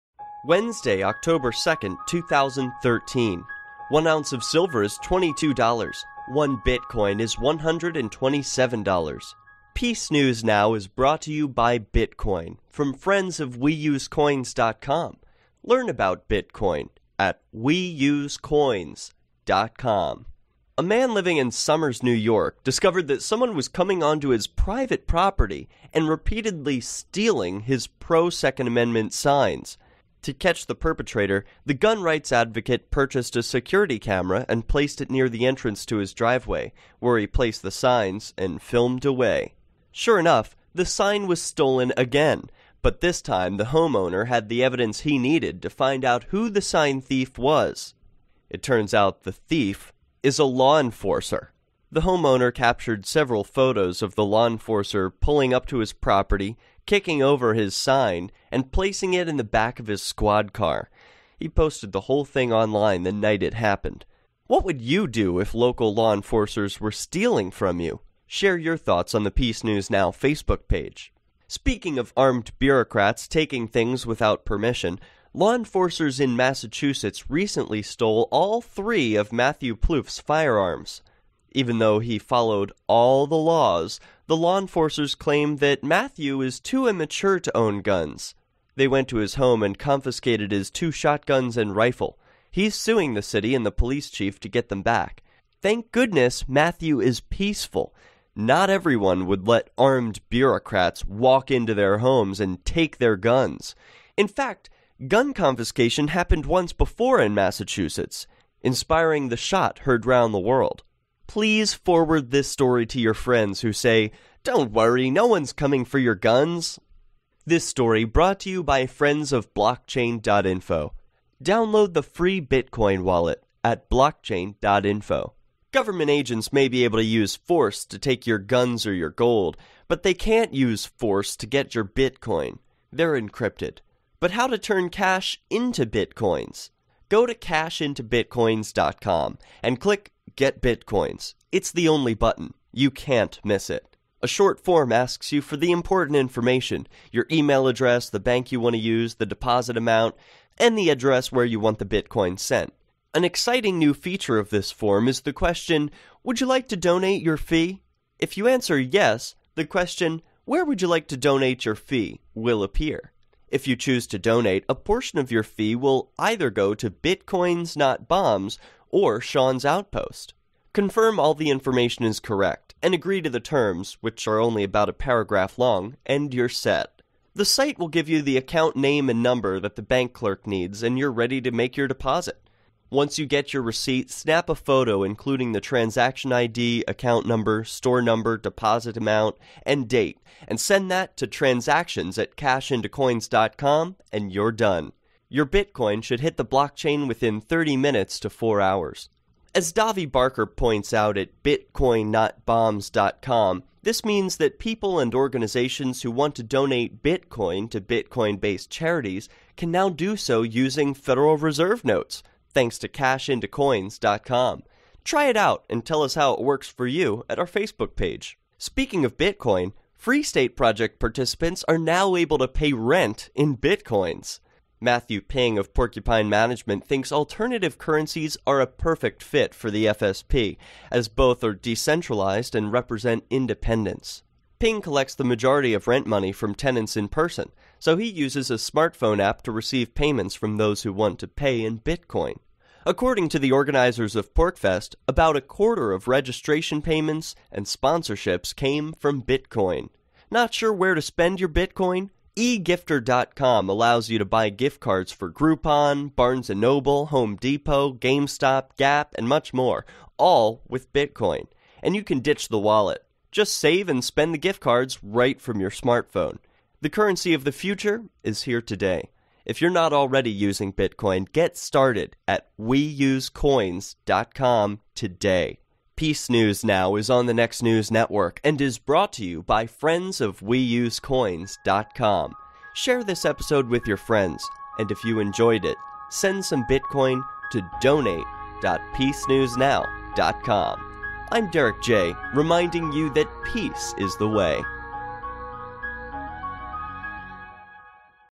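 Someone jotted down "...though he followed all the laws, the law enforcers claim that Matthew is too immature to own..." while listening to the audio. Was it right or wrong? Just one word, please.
right.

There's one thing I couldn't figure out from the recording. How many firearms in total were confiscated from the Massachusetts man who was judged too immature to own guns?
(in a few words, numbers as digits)
3.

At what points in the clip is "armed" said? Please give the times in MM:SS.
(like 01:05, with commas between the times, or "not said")
01:12, 01:39.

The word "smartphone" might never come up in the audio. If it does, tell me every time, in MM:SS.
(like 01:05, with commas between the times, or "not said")
03:58, 04:25.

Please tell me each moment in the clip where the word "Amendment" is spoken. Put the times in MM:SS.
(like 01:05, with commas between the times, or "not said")
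00:28.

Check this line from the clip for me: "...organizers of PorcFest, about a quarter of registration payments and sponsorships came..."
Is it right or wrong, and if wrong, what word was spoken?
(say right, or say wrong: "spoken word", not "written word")
right.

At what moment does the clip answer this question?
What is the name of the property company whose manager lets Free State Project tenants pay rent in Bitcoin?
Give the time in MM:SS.
03:45.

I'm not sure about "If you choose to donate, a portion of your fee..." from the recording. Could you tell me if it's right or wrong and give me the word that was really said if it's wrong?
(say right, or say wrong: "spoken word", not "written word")
right.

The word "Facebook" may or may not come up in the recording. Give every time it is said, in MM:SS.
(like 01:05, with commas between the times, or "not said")
01:10, 03:37.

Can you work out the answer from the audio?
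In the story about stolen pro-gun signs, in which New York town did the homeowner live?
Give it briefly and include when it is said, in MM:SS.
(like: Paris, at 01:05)
Somers, at 00:21.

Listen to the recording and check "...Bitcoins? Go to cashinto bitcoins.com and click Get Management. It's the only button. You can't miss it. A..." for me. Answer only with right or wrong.
wrong.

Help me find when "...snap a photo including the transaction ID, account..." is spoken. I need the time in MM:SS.
03:04.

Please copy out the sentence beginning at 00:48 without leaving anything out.
It turns out the thief is a law enforcer.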